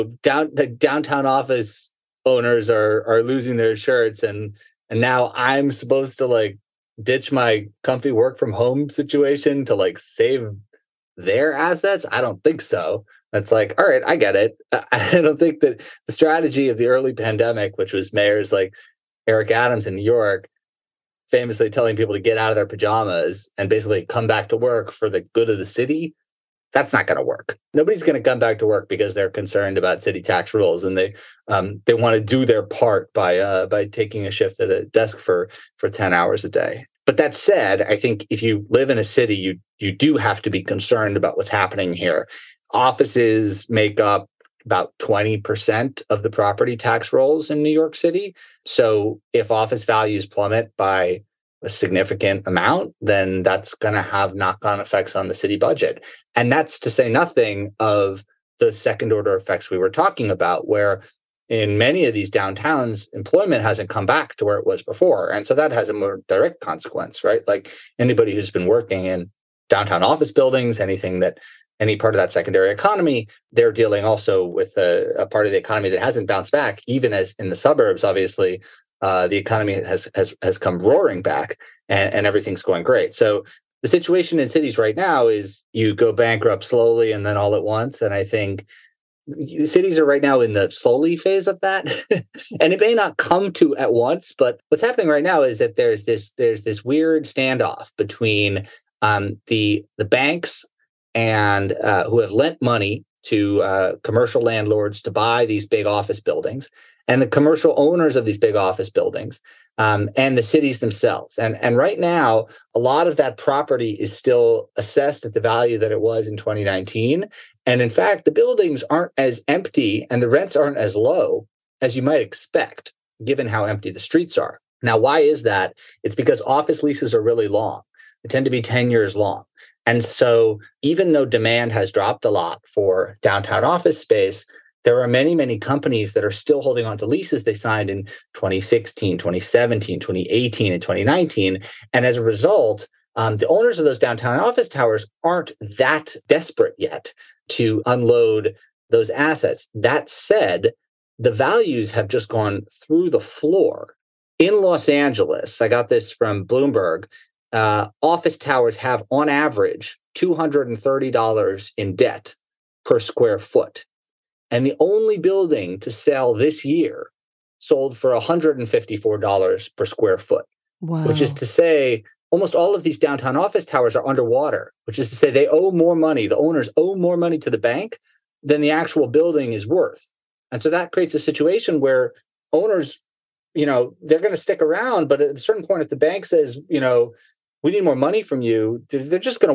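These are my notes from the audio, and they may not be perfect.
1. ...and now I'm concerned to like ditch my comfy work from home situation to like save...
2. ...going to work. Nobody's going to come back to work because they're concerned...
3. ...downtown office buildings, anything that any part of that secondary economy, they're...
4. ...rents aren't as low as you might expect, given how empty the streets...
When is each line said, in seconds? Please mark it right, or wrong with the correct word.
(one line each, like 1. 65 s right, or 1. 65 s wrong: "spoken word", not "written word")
1. 4 s wrong: "supposed", not "concerned"
2. 27 s right
3. 69 s right
4. 120 s right.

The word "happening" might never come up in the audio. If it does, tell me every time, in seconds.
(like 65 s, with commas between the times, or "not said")
41 s, 94 s.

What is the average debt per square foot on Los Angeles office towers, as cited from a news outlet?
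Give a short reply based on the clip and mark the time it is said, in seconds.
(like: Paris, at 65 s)
$230, at 160 s.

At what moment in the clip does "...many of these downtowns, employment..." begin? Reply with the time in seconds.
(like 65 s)
61 s.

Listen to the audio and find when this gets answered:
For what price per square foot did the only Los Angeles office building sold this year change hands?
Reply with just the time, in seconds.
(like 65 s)
168 s.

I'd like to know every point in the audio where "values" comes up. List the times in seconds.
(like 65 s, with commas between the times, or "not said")
49 s, 115 s, 151 s.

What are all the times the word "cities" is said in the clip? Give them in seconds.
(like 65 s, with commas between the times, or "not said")
84 s, 89 s, 110 s.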